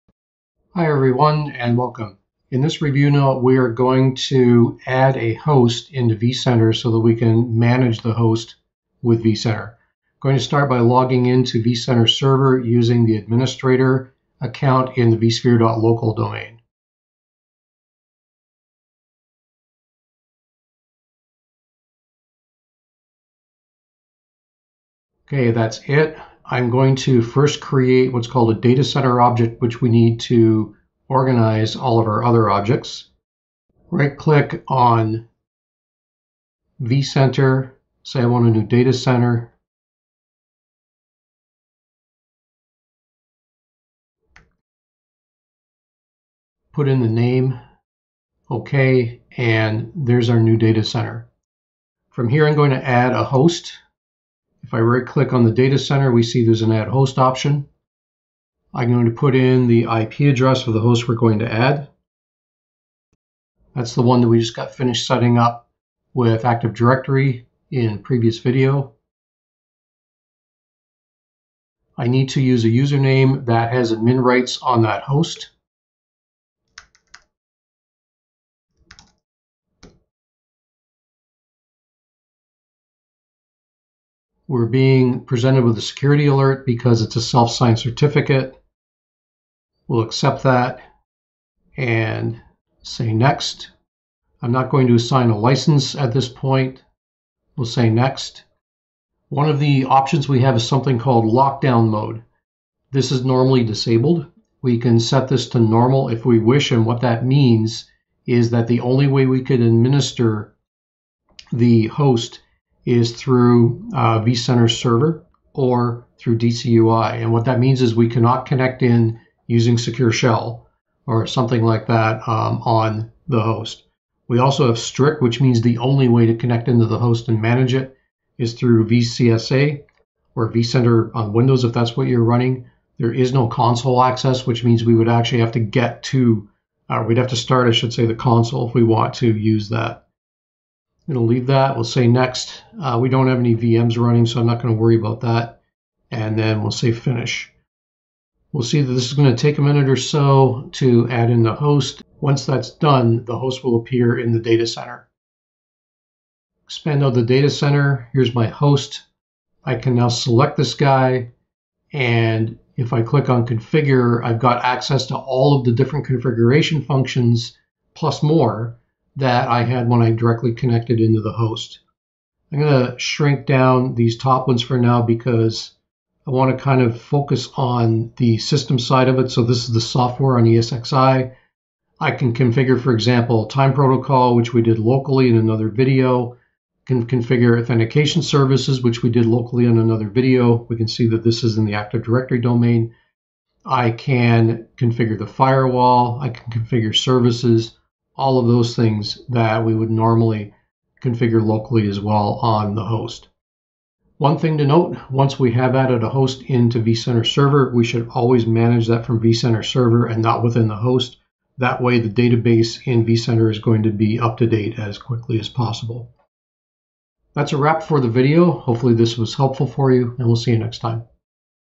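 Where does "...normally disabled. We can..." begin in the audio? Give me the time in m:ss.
1:43.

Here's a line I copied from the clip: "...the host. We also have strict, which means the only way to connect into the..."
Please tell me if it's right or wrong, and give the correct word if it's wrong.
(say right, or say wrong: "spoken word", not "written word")
right.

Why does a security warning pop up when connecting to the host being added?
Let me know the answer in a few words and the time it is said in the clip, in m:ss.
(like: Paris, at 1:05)
self-signed certificate, at 1:27.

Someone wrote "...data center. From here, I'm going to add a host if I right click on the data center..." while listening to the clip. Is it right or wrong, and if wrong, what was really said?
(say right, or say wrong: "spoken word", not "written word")
right.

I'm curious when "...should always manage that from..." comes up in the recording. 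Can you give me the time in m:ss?
3:27.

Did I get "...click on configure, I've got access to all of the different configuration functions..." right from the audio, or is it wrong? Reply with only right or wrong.
right.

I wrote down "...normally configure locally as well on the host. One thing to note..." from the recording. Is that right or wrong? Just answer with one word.
right.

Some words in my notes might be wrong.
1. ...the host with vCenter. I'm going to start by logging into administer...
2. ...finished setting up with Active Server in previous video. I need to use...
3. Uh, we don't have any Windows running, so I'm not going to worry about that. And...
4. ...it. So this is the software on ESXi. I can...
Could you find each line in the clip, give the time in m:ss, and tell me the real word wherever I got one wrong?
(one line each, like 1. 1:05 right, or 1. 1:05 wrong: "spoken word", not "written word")
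1. 0:07 wrong: "vCenter", not "administer"
2. 1:04 wrong: "Directory", not "Server"
3. 2:22 wrong: "VMs", not "Windows"
4. 2:59 right.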